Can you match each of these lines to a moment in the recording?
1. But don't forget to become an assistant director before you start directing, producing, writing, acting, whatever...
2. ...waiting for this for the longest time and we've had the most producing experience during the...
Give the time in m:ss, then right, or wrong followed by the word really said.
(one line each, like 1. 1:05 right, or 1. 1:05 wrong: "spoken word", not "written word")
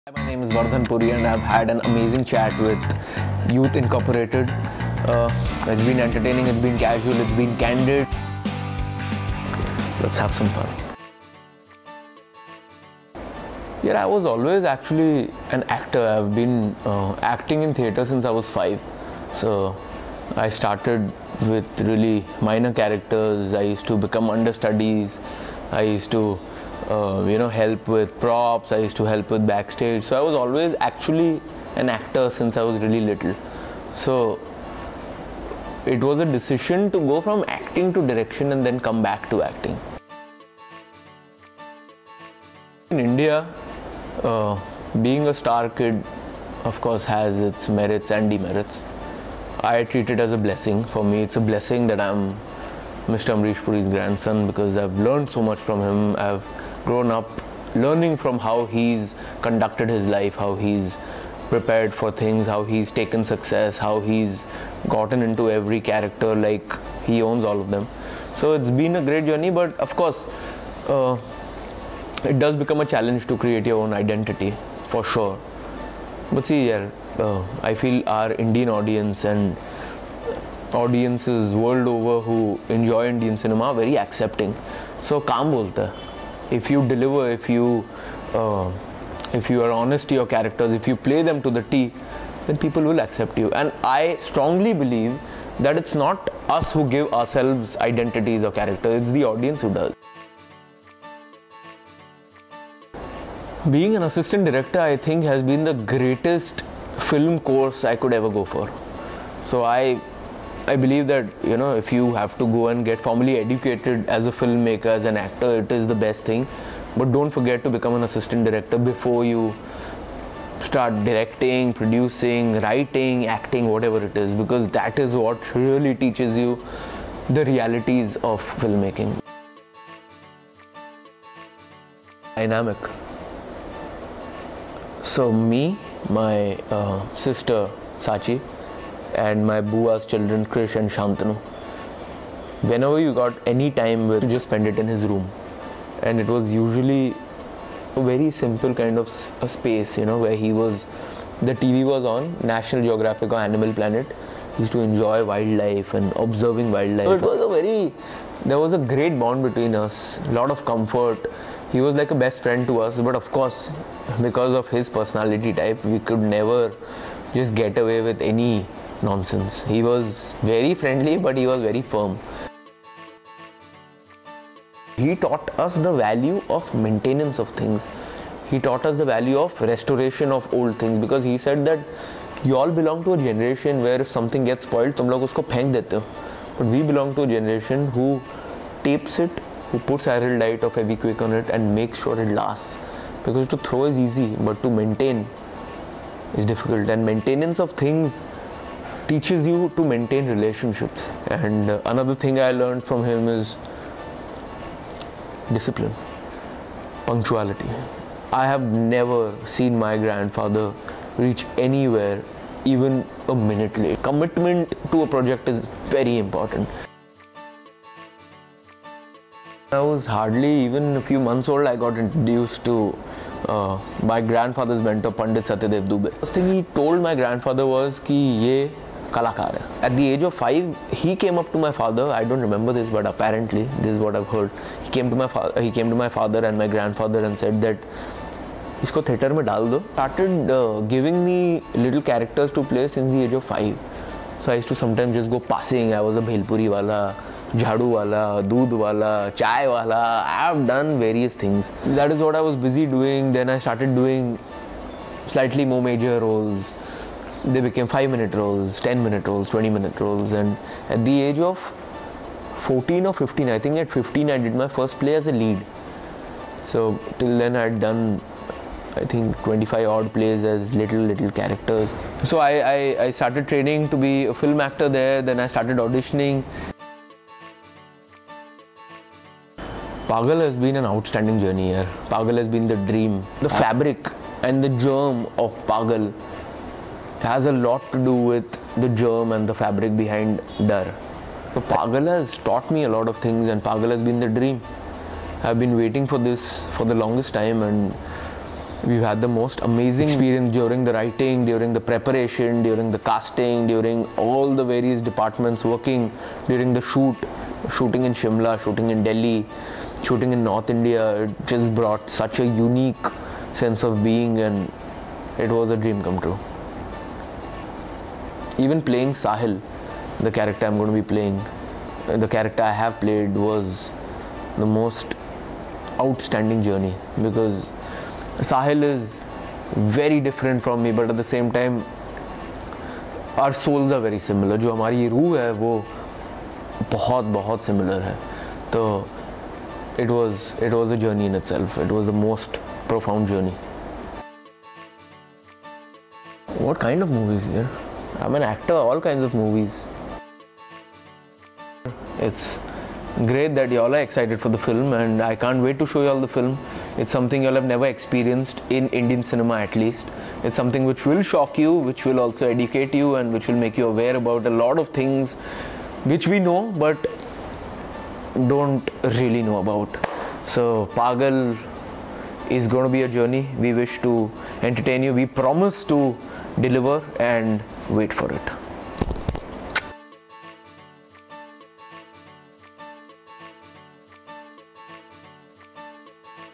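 1. 1:56 right
2. 4:55 wrong: "amazing", not "producing".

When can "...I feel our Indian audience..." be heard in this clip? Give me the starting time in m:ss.
1:17.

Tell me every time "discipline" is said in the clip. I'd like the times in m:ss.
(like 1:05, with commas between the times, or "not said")
3:25.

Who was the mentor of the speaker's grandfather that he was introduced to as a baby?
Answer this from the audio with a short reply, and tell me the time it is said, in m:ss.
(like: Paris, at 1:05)
Pandit Satyadev Dubey, at 3:45.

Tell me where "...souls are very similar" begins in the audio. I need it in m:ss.
5:33.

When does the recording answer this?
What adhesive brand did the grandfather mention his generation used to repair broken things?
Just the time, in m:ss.
3:10.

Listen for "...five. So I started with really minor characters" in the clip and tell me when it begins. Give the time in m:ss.
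0:18.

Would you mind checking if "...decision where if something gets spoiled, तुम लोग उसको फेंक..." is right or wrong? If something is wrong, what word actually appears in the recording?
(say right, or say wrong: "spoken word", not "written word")
wrong: "generation", not "decision".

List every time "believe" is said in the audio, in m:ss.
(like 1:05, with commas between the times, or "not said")
1:34, 1:50.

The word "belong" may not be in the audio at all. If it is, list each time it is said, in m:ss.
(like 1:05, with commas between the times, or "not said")
3:02, 3:06.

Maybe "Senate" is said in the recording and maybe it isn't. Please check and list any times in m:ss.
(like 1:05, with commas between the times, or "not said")
not said.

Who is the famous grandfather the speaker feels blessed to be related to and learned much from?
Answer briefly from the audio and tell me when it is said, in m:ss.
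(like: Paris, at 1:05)
Amrish Puri, at 0:53.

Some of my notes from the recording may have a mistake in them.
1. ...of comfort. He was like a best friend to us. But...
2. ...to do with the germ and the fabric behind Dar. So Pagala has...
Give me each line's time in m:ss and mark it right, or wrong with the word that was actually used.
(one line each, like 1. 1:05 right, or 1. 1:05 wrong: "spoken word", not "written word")
1. 2:40 right
2. 4:47 right.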